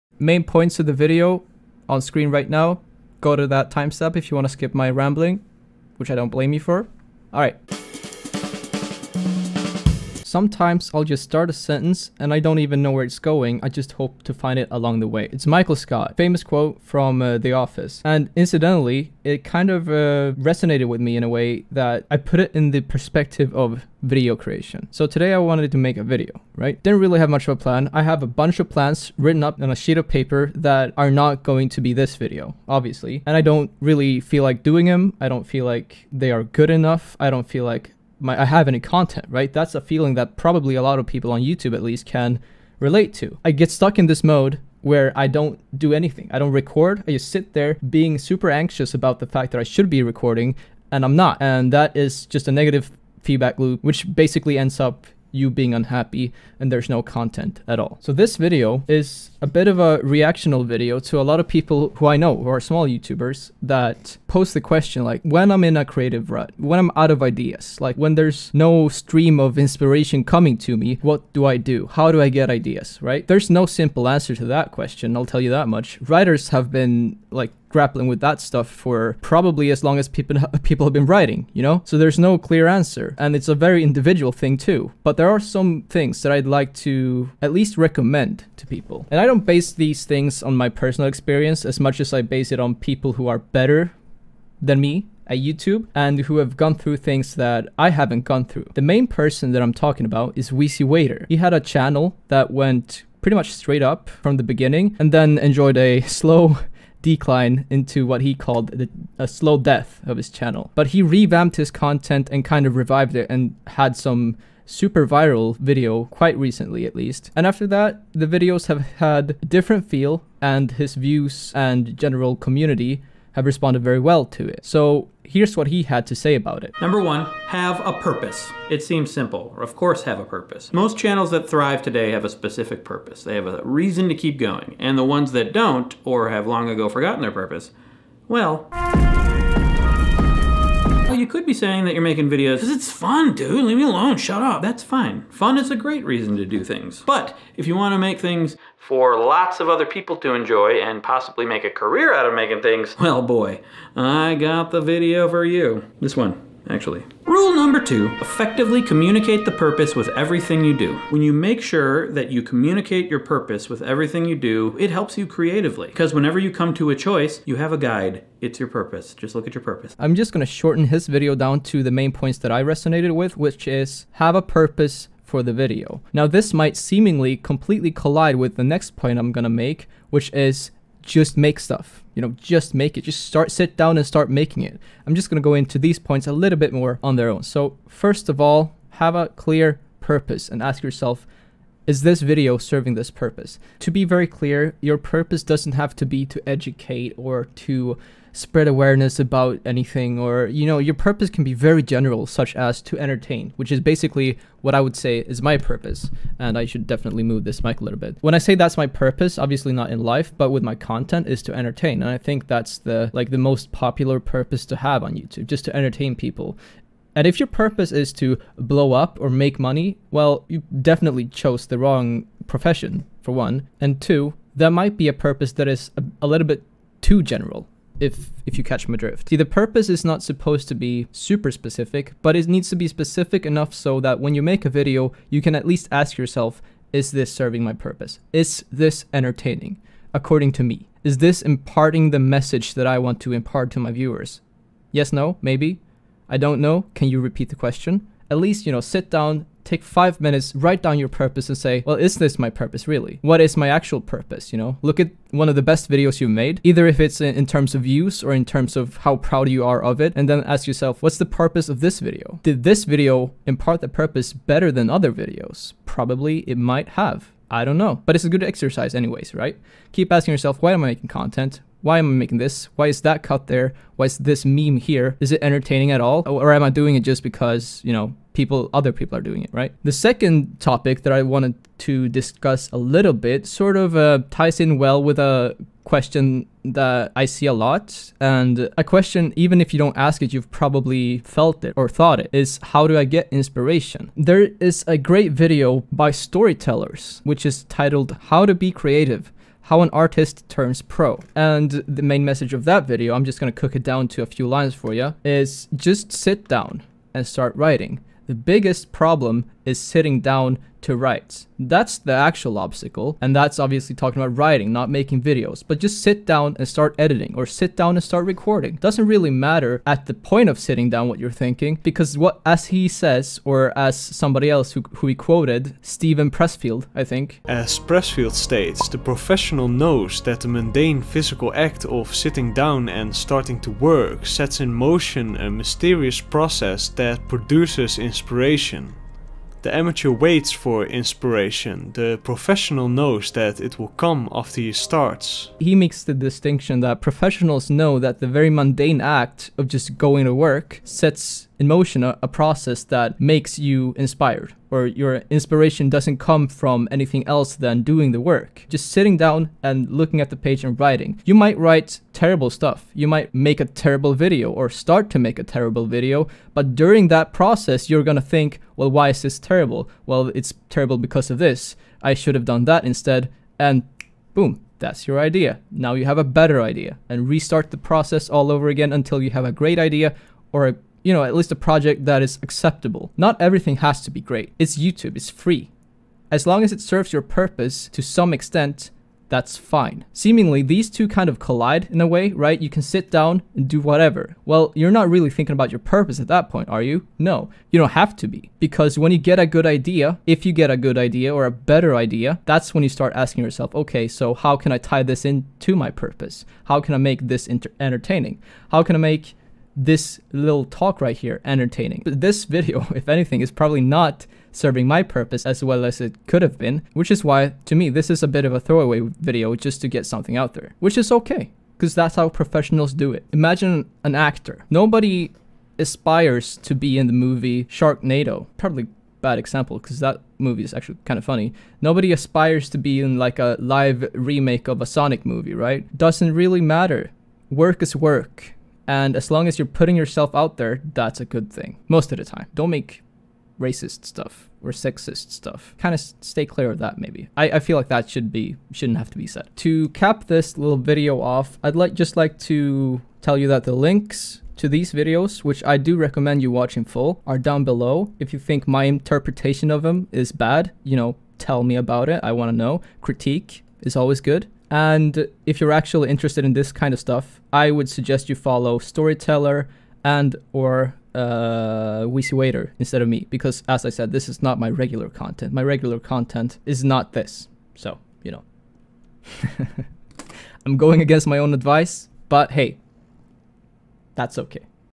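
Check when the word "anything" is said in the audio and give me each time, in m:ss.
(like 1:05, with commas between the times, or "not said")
0:45, 3:19, 5:56, 6:53.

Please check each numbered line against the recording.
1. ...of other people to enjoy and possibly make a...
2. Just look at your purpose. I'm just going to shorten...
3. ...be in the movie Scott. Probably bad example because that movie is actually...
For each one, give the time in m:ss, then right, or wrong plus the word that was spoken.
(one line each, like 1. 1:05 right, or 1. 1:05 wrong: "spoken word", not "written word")
1. 2:29 right
2. 2:49 right
3. 7:06 wrong: "Sharknado", not "Scott".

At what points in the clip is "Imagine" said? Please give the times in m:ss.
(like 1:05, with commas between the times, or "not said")
7:03.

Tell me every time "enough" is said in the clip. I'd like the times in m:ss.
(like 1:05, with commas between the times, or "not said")
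0:36, 3:53.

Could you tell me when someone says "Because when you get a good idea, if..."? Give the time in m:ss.
6:38.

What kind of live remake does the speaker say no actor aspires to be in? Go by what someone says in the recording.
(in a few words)
a Sonic movie.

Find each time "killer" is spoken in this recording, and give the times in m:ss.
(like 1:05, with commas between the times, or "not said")
not said.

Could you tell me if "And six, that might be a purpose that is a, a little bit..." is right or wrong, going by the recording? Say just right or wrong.
wrong.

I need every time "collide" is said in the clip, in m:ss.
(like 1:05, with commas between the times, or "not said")
2:57, 6:31.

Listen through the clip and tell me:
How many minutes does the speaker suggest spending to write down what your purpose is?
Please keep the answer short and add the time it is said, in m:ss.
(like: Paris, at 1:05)
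5, at 4:09.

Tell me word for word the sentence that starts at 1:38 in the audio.
The main person that I'm talking about is Wheezy Waiter.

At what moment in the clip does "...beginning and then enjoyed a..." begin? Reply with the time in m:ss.
1:44.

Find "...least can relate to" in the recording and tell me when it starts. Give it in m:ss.
0:41.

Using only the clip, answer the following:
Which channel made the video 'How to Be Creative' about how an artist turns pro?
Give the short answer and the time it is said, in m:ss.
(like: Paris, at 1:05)
Storyteller, at 4:56.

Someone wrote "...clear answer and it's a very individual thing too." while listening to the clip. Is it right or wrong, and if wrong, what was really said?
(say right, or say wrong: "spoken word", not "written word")
right.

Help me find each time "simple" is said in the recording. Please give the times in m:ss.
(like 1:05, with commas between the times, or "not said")
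1:13, 2:09.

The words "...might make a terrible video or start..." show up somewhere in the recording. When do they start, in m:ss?
6:03.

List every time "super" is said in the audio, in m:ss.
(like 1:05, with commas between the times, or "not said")
0:48, 1:54, 3:51.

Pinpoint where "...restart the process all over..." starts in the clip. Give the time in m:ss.
6:17.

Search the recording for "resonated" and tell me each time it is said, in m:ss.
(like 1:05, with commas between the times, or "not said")
0:20, 2:52.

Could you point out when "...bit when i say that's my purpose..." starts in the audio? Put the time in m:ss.
3:27.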